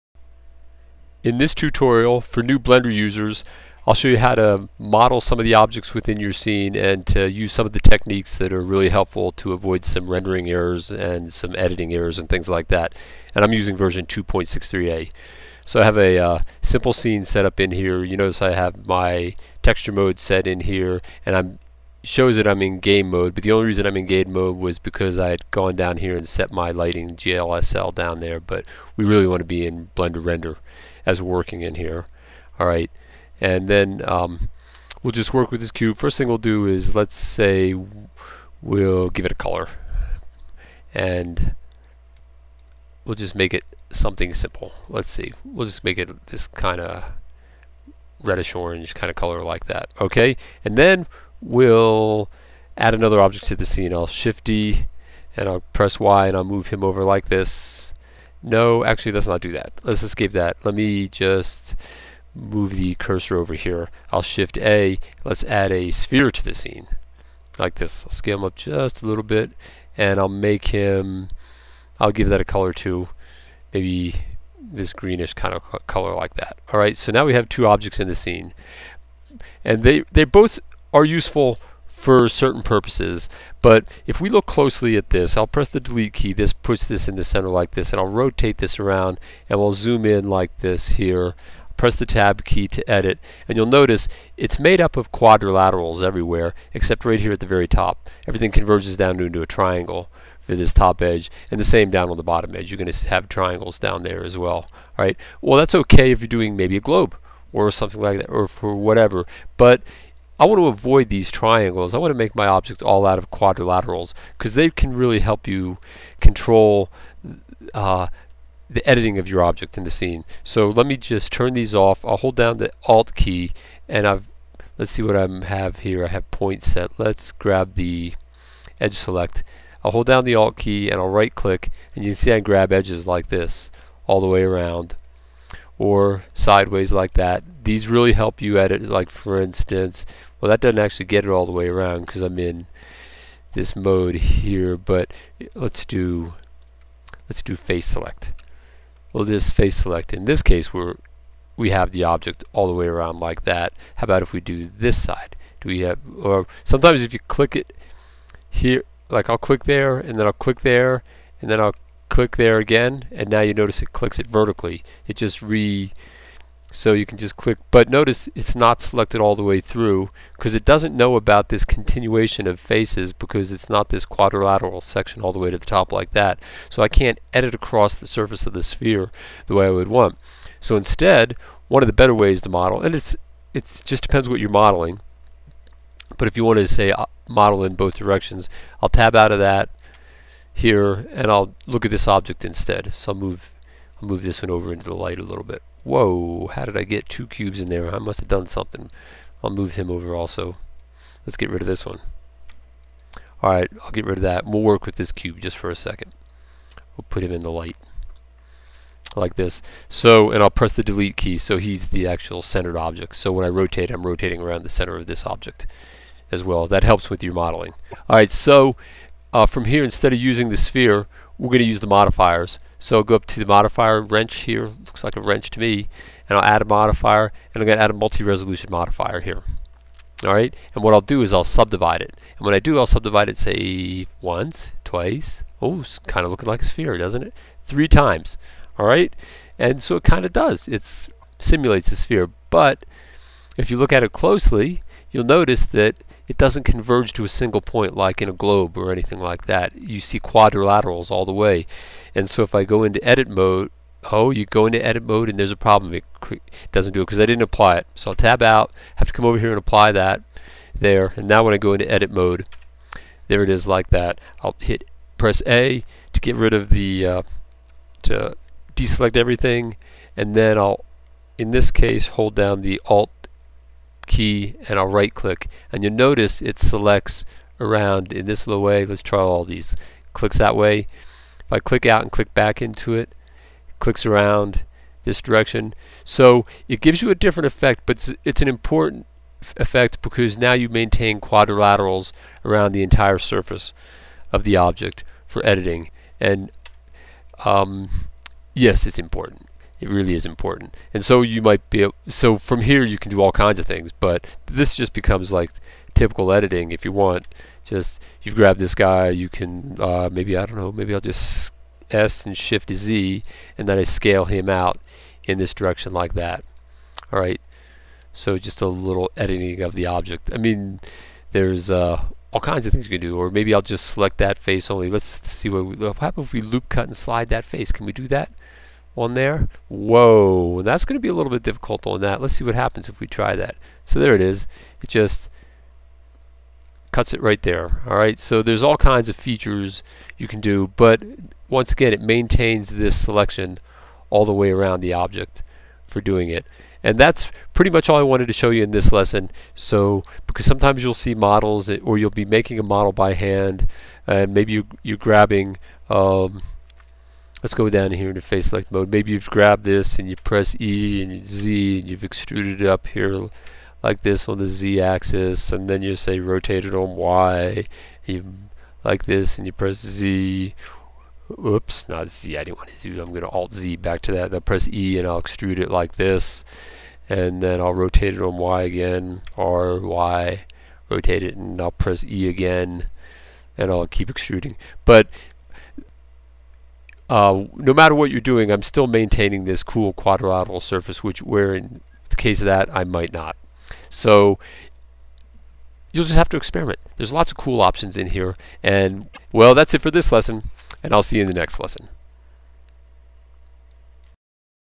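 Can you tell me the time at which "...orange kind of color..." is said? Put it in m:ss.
0:48.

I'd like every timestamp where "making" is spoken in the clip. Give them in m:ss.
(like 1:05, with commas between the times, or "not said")
5:52.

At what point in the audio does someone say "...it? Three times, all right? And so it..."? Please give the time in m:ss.
3:57.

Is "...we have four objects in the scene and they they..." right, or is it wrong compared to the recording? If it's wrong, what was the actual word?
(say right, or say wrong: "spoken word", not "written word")
wrong: "two", not "four".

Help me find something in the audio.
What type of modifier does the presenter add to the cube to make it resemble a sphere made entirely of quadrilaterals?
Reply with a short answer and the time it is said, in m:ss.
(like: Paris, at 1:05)
Multi-resolution modifier, at 3:47.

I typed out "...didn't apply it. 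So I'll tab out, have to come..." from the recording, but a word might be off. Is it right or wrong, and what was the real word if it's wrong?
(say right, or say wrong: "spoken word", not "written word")
right.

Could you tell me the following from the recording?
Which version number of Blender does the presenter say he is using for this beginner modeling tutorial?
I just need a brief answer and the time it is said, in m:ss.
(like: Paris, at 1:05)
2.63a, at 0:14.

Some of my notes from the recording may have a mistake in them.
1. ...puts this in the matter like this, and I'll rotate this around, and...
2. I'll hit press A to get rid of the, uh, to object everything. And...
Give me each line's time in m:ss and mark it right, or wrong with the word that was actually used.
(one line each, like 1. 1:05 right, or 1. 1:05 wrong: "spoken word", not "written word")
1. 1:26 wrong: "center", not "matter"
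2. 4:24 wrong: "deselect", not "object".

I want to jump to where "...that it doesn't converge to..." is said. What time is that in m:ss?
4:05.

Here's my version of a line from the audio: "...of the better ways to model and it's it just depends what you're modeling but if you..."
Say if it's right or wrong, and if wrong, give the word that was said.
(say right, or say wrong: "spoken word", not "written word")
right.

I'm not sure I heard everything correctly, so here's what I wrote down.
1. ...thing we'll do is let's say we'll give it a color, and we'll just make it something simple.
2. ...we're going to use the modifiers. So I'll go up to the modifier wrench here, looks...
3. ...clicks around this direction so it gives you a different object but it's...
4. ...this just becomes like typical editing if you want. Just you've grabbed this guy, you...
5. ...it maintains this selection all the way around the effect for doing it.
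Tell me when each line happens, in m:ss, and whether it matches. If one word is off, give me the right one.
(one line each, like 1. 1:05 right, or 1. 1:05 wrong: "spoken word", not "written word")
1. 0:36 right
2. 3:41 right
3. 4:43 wrong: "effect", not "object"
4. 5:04 right
5. 5:41 wrong: "object", not "effect".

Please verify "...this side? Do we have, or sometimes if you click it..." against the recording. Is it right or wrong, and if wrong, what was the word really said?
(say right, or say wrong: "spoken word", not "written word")
right.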